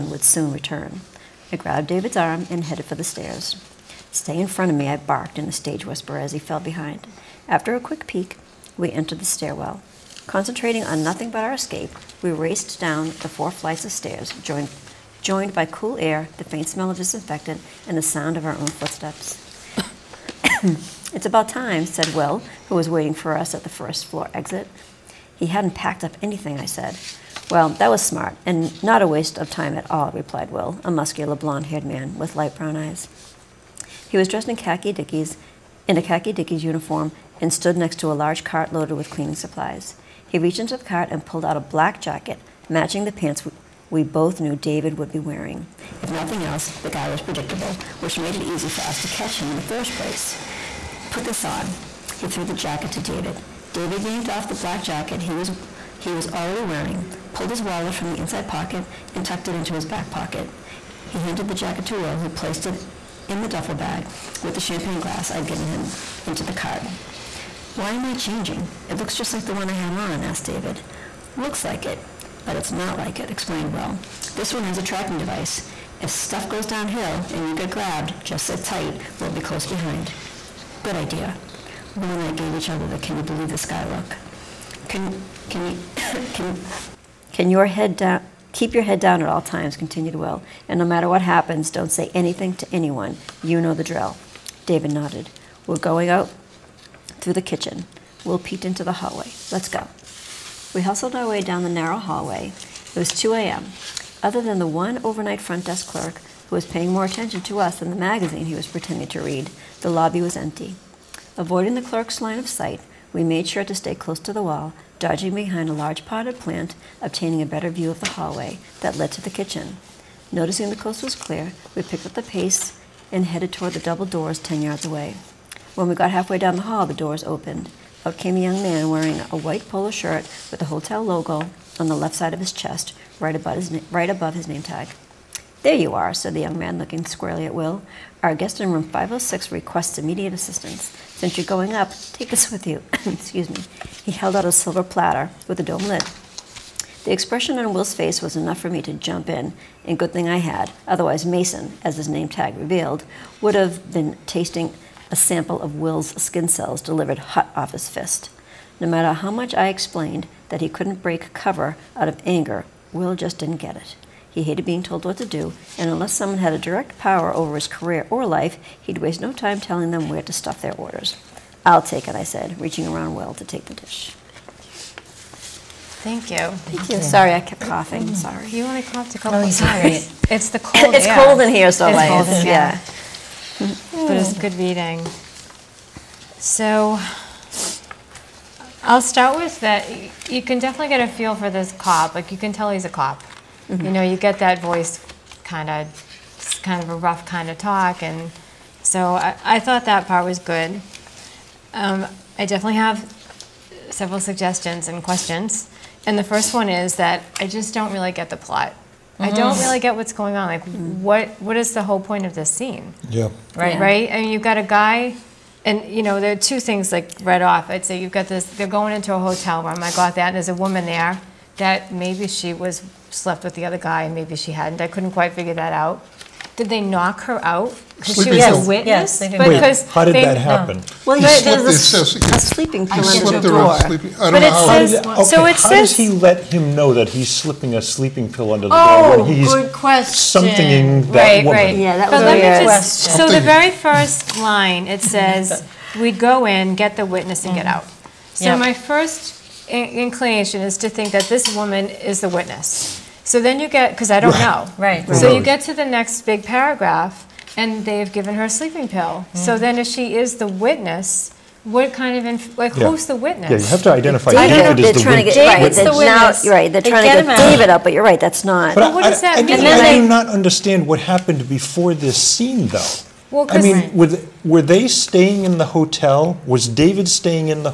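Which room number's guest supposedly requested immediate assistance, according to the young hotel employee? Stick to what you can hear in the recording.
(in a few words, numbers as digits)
506.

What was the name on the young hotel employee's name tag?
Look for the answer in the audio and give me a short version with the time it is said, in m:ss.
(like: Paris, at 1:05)
Mason, at 2:31.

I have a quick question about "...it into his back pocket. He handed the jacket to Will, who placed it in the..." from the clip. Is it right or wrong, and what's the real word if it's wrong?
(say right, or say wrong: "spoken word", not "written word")
right.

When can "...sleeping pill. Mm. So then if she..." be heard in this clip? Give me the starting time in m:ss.
4:18.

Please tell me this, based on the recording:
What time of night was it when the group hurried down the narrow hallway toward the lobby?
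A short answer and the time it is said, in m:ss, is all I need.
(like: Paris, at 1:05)
2 a.m., at 1:43.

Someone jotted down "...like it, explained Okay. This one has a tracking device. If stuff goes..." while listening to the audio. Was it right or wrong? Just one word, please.
wrong.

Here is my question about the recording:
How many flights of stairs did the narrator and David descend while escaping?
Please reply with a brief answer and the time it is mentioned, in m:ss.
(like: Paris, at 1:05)
4, at 0:13.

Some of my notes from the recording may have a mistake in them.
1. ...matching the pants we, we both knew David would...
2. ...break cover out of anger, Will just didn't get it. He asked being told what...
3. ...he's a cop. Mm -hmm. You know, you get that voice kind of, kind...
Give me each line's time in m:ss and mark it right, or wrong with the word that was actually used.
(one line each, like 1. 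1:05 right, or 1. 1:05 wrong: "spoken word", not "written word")
1. 0:42 right
2. 2:41 wrong: "hated", not "asked"
3. 3:12 right.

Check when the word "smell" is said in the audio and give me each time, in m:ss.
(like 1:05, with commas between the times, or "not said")
0:16.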